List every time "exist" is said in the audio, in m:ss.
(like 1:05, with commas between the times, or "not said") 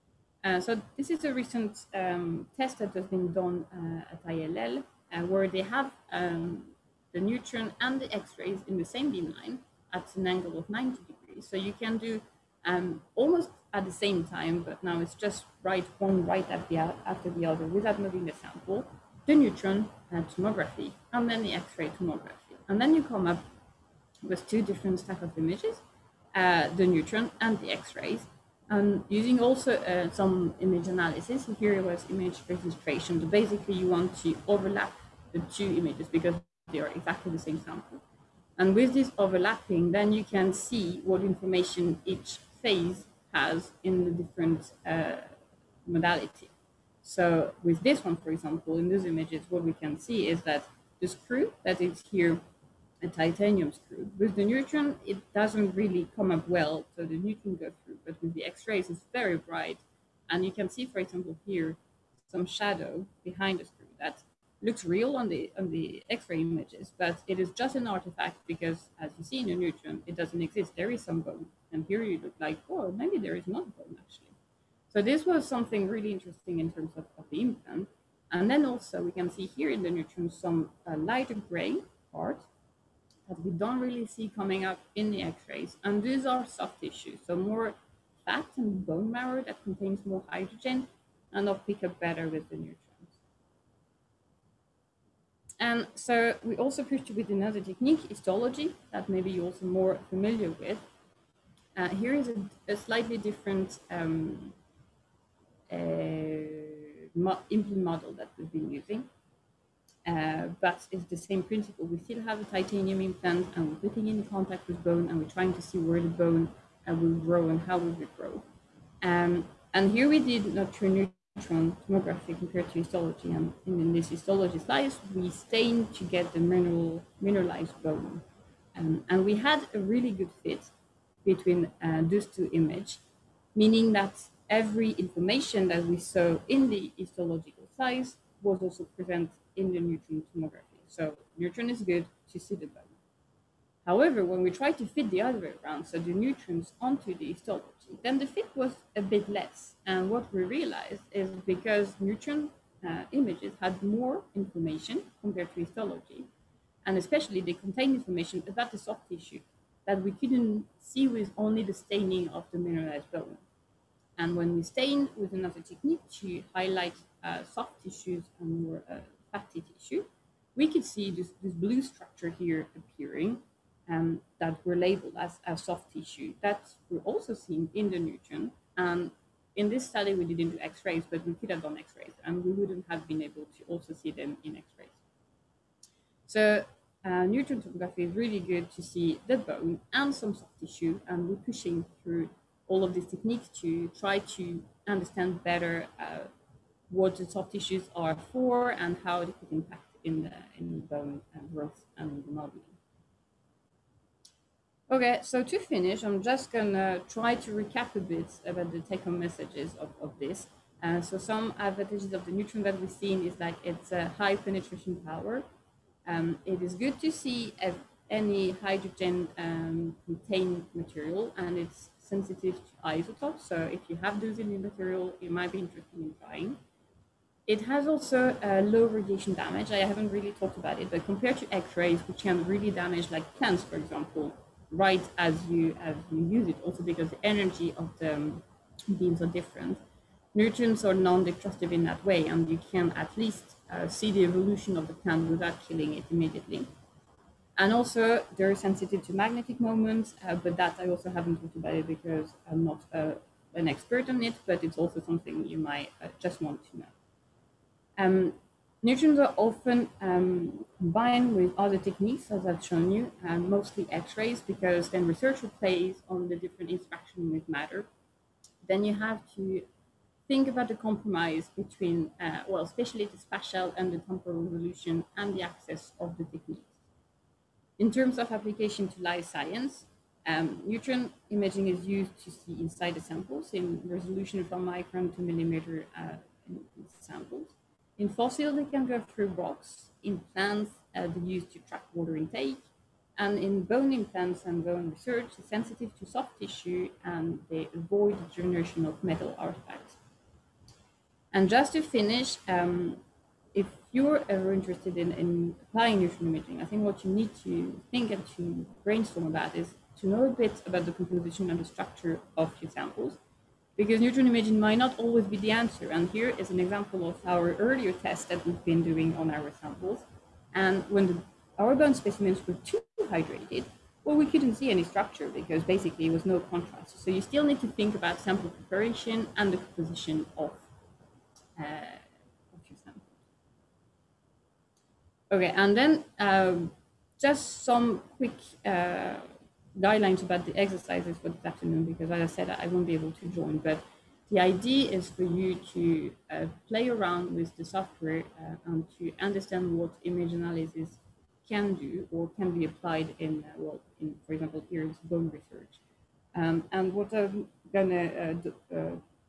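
1:10.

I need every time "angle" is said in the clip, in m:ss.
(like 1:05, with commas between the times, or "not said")
0:10.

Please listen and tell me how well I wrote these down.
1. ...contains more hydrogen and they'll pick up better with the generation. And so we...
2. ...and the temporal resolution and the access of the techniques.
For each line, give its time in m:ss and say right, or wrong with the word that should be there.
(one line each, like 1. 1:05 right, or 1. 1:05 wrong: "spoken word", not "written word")
1. 1:29 wrong: "neutron", not "generation"
2. 4:33 right.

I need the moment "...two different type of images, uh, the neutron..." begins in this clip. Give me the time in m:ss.
0:24.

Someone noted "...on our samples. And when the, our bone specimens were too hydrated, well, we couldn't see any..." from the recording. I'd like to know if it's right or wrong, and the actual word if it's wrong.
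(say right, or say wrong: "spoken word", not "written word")
right.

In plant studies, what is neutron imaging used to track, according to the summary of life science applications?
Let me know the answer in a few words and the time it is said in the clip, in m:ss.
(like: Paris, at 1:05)
Water intake, at 4:51.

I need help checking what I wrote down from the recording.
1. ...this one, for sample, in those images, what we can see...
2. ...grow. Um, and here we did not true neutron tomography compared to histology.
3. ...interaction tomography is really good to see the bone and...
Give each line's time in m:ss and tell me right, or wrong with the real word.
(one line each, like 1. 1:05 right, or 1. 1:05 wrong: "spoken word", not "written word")
1. 0:47 wrong: "example", not "sample"
2. 1:58 right
3. 3:07 wrong: "neutron", not "interaction".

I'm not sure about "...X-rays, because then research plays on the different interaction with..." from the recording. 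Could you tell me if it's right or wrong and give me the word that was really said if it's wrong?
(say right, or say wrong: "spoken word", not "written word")
right.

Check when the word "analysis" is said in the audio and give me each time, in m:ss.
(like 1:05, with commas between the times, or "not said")
0:30, 5:50.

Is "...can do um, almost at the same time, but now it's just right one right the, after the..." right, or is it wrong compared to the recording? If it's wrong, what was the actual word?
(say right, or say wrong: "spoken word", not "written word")
right.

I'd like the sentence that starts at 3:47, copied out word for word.
It has also a uh, low radiation damage.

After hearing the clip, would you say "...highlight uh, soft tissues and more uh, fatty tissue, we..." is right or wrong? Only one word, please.
right.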